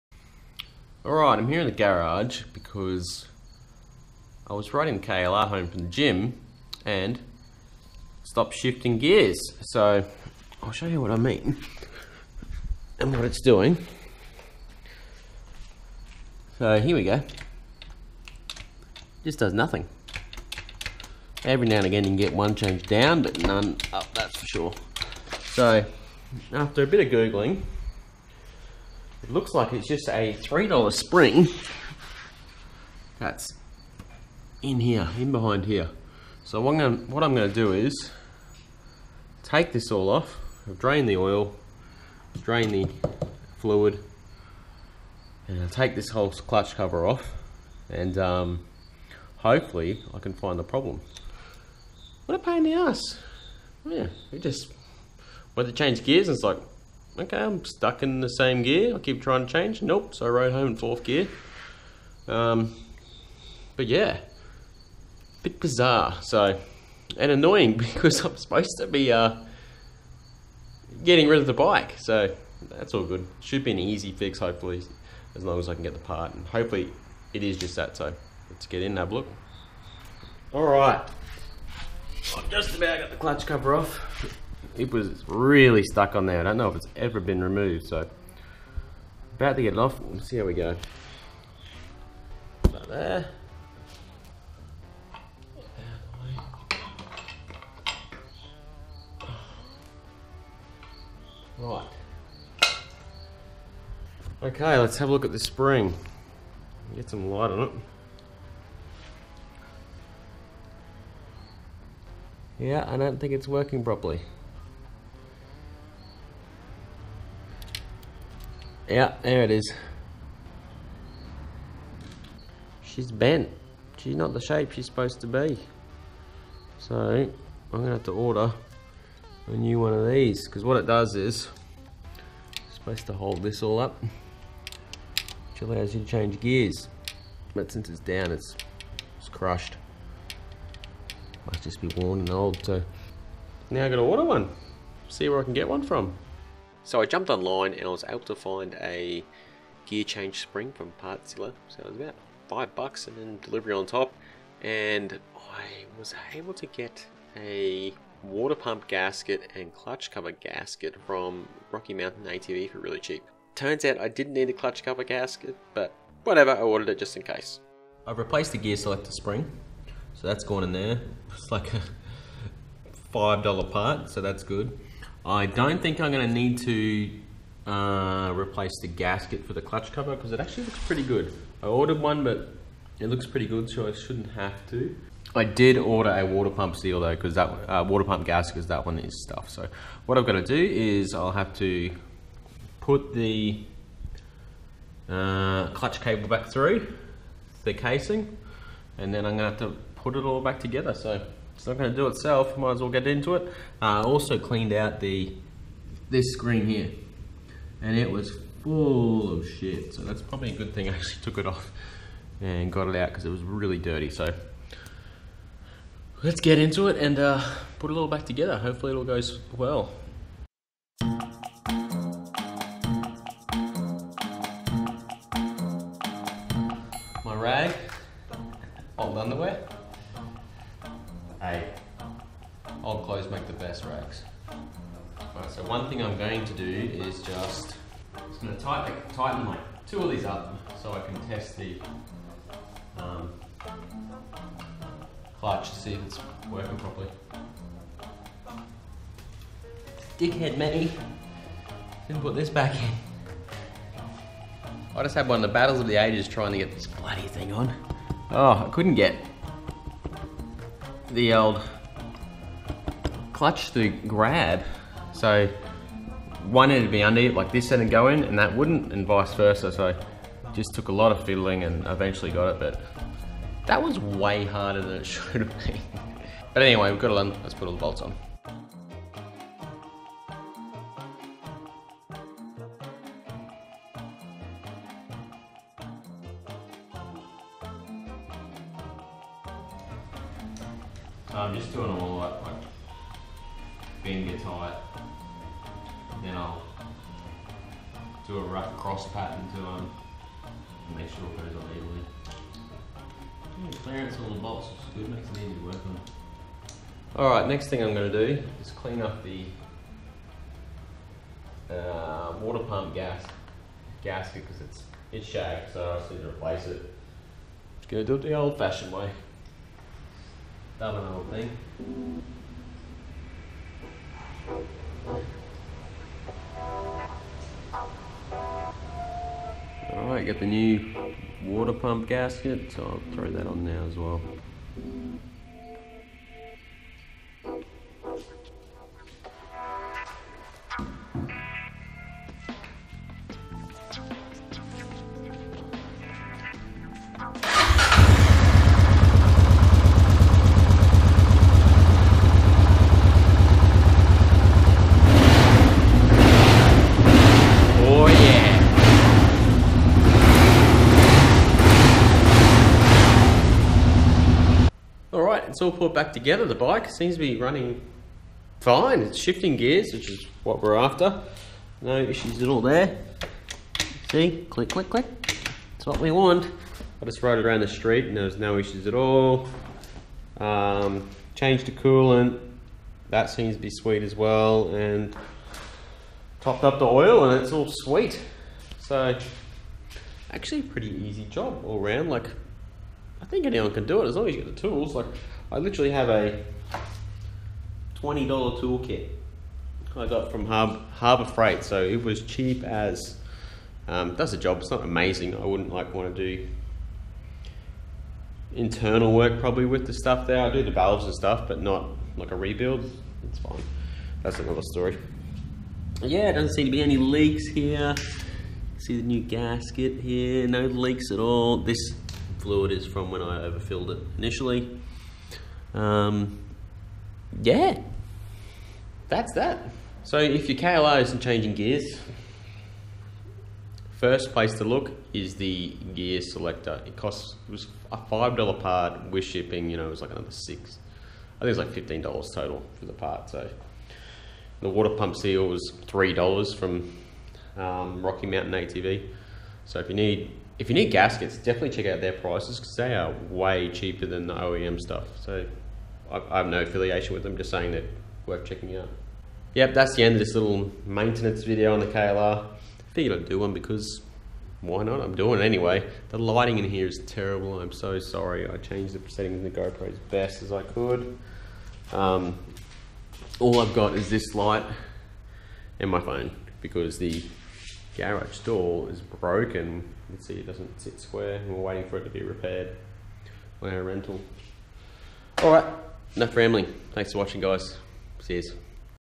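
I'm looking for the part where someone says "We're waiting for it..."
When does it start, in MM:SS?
08:01.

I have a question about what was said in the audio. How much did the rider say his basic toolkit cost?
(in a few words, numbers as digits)
$20.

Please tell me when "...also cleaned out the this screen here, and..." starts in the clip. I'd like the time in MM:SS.
03:24.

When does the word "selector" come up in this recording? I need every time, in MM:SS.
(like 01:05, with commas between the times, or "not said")
02:48, 07:16.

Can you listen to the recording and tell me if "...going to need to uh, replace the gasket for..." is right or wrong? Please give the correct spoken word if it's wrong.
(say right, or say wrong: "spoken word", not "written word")
right.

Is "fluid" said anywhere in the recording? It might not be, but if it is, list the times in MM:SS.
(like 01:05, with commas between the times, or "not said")
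00:43, 07:02.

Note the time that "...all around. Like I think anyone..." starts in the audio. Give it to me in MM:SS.
06:31.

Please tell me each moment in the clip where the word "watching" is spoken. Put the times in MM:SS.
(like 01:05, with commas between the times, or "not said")
08:07.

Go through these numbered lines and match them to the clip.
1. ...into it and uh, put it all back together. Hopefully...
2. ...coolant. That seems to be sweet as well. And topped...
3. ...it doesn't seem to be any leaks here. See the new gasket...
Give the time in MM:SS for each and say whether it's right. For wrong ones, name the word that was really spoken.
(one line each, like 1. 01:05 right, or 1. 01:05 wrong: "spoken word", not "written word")
1. 03:36 right
2. 06:21 right
3. 06:56 right.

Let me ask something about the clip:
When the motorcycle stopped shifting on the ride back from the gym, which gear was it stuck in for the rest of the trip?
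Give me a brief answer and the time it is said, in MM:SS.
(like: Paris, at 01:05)
fourth gear, at 01:00.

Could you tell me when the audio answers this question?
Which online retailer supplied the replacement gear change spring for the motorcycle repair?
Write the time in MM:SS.
02:31.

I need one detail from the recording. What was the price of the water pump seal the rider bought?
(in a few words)
$3.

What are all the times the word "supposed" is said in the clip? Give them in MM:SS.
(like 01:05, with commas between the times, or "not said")
01:08, 02:04, 02:12.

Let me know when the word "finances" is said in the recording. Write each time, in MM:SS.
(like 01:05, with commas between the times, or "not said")
not said.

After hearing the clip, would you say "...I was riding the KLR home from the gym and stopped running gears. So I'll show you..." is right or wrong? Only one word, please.
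wrong.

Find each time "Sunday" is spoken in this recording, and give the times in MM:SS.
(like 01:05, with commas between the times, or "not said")
not said.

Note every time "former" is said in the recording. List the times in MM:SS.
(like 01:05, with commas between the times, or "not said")
not said.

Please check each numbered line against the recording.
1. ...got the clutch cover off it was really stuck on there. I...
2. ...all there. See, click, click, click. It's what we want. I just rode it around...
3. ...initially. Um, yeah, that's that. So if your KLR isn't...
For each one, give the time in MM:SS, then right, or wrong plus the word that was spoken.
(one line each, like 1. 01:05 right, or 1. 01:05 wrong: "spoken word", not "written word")
1. 01:22 right
2. 06:12 right
3. 07:04 right.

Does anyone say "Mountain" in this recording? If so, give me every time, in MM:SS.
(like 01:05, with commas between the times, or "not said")
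02:41, 07:28.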